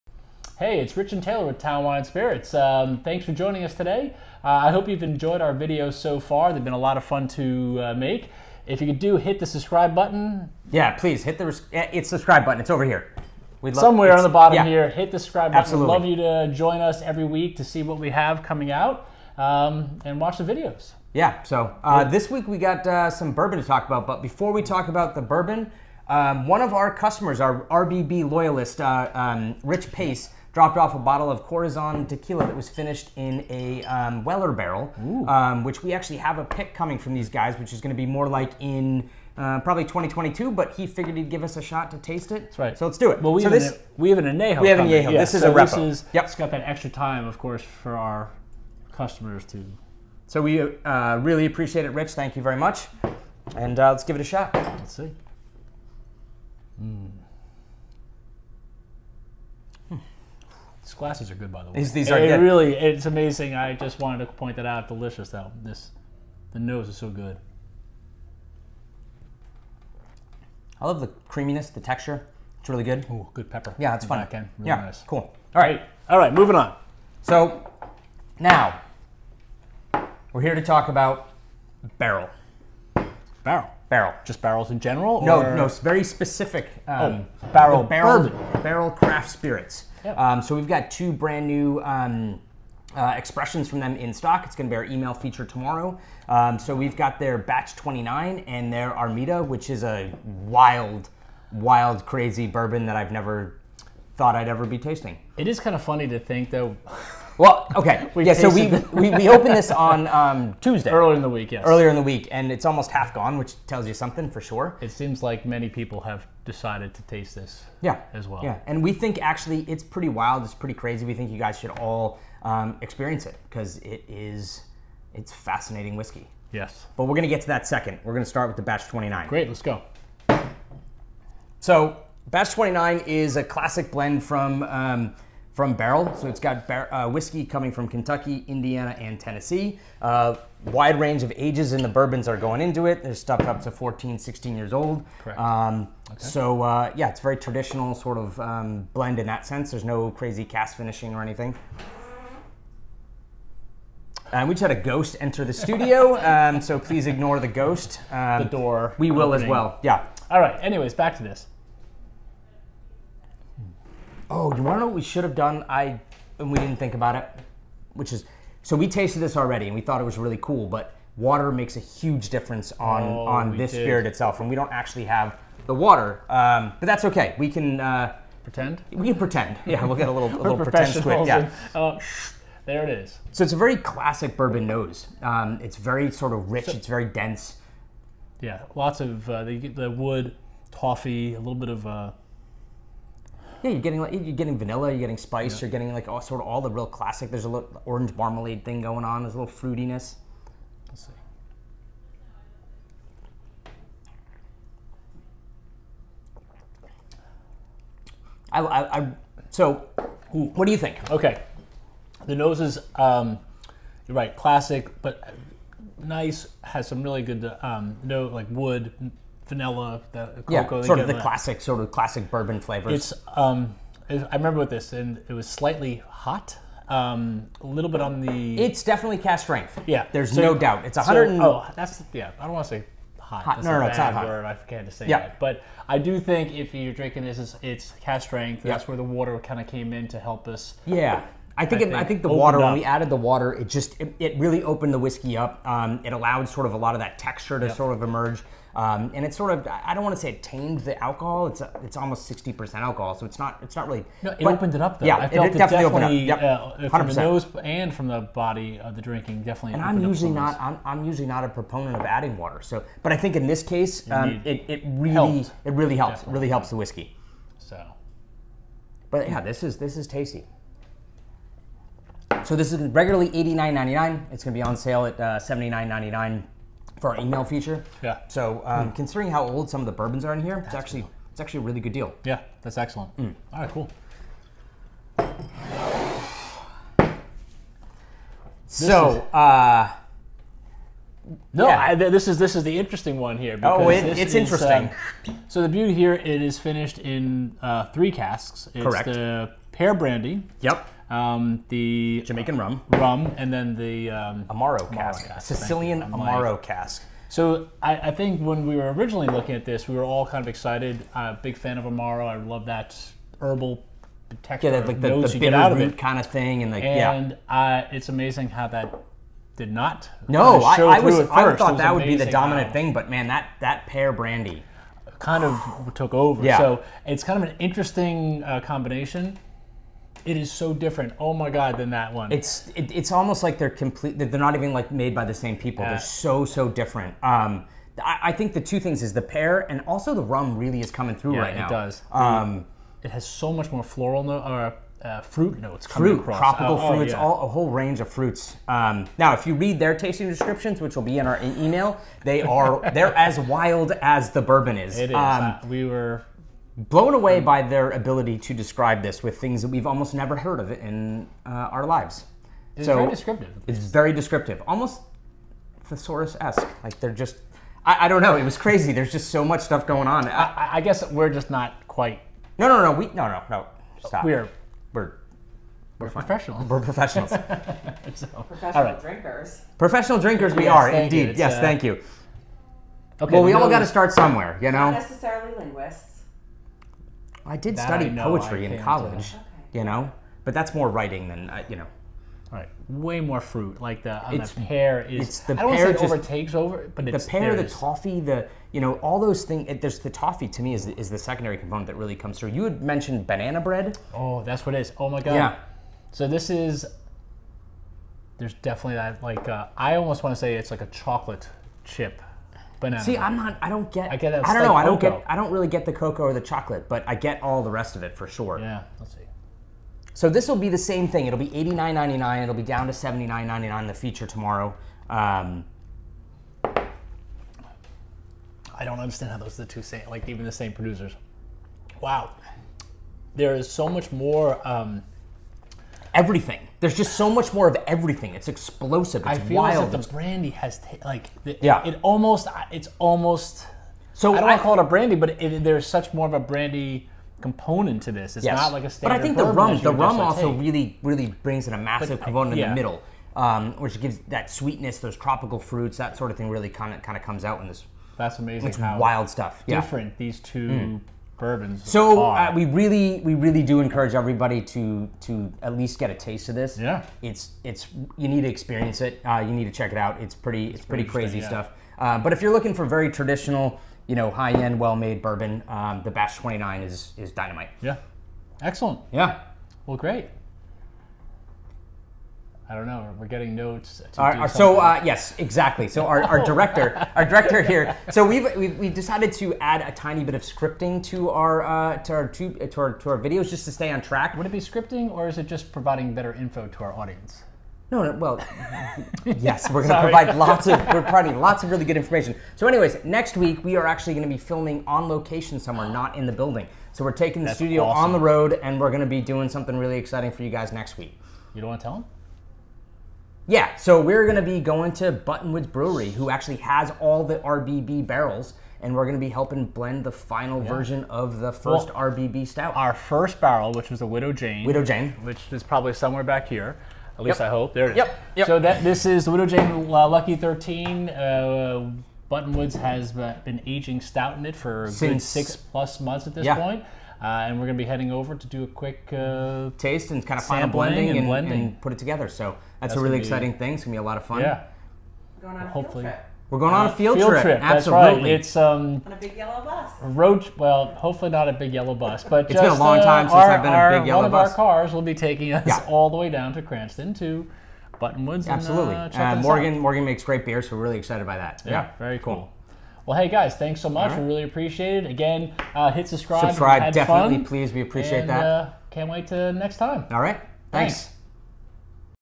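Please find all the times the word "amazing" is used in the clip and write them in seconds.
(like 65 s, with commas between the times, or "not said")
63 s, 318 s, 458 s.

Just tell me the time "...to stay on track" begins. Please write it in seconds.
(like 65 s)
493 s.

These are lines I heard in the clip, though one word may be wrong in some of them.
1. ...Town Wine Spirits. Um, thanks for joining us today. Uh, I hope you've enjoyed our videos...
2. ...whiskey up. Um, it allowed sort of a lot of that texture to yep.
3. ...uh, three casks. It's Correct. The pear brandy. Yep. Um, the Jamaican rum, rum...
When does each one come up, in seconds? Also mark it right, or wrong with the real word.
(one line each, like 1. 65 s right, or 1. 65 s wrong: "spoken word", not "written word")
1. 1 s right
2. 244 s right
3. 297 s right.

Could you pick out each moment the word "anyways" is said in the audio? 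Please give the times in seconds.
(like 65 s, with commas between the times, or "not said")
160 s, 502 s.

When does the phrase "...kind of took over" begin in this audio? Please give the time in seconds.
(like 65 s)
325 s.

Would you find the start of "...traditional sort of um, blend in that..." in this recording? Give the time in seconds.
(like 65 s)
147 s.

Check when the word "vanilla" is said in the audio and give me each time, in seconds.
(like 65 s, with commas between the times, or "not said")
194 s, 219 s.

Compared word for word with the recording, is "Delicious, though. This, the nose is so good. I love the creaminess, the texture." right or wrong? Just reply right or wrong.
right.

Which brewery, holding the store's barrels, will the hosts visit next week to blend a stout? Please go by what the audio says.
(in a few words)
Buttonwoods Brewery.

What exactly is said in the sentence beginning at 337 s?
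Um, I, I, think the two things is the pear and also the rum really is coming through yeah, right now.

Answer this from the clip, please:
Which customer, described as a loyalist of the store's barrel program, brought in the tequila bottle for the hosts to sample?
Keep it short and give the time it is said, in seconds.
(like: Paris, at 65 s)
Rich Pace, at 29 s.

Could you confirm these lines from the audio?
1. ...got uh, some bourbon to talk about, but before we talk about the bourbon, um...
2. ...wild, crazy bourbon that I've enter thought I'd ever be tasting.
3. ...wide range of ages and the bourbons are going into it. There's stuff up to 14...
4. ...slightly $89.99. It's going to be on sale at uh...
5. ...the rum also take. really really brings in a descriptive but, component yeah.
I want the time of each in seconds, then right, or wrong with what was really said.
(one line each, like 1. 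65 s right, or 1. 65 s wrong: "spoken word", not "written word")
1. 22 s right
2. 101 s wrong: "never", not "enter"
3. 140 s right
4. 272 s wrong: "regularly", not "slightly"
5. 449 s wrong: "massive", not "descriptive".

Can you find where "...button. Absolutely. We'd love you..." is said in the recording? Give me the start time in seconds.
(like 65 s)
15 s.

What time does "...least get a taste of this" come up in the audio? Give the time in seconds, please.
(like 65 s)
465 s.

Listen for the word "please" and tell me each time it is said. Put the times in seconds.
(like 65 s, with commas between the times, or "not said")
10 s, 156 s, 567 s.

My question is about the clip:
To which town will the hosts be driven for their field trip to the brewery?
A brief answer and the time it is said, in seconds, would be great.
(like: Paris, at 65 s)
Cranston, at 556 s.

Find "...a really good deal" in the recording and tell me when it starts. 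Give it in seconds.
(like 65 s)
281 s.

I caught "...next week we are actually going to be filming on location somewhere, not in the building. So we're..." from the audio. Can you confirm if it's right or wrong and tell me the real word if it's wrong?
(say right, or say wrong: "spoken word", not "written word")
right.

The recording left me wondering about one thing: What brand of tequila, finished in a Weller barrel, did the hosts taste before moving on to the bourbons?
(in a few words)
Corazon.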